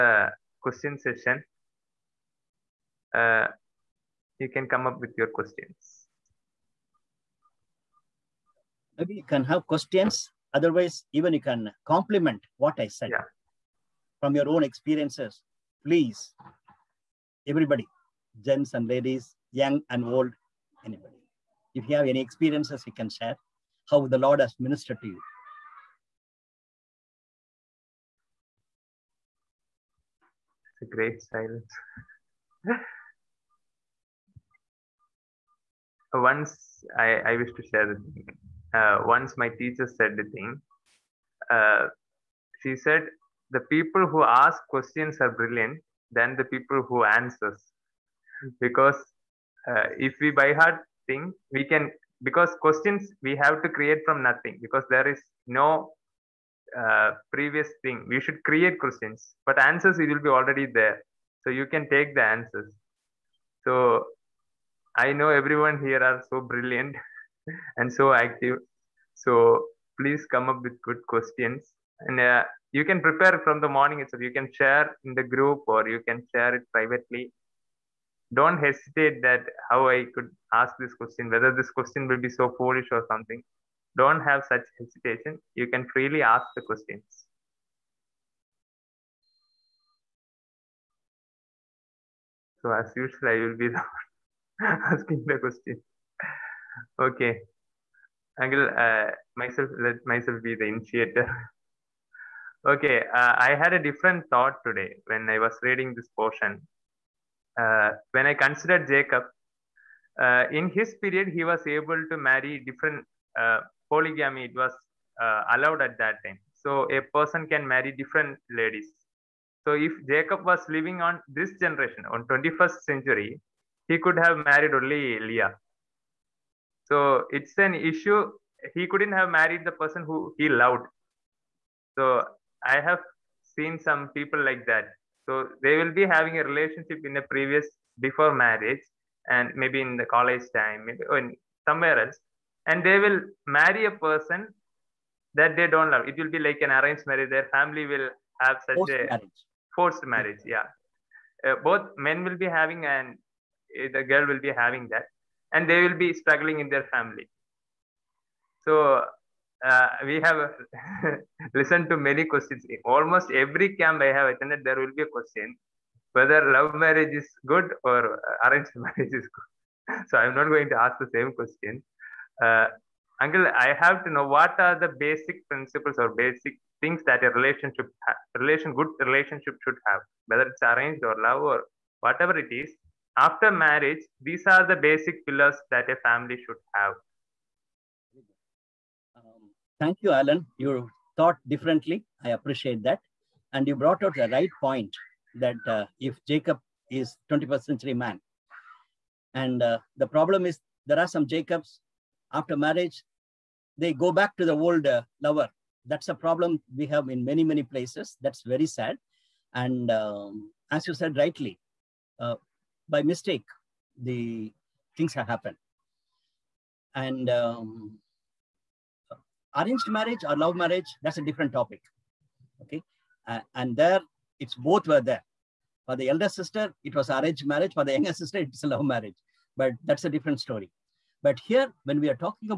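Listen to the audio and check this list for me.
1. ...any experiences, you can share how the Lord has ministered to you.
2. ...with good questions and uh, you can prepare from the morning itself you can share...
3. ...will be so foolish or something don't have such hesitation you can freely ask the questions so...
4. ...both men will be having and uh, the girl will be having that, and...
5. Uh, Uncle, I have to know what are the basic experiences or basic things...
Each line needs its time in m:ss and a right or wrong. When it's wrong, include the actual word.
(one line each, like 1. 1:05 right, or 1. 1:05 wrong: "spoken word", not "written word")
1. 0:22 right
2. 1:10 right
3. 1:22 right
4. 2:31 right
5. 2:52 wrong: "principles", not "experiences".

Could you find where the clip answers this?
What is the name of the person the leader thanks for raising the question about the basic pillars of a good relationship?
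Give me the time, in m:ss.
3:10.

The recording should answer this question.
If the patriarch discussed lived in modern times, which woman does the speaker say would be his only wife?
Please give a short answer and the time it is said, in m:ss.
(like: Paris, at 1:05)
Leah, at 2:05.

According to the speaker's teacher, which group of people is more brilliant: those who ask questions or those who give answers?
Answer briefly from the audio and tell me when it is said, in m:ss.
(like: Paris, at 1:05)
People who ask questions, at 0:43.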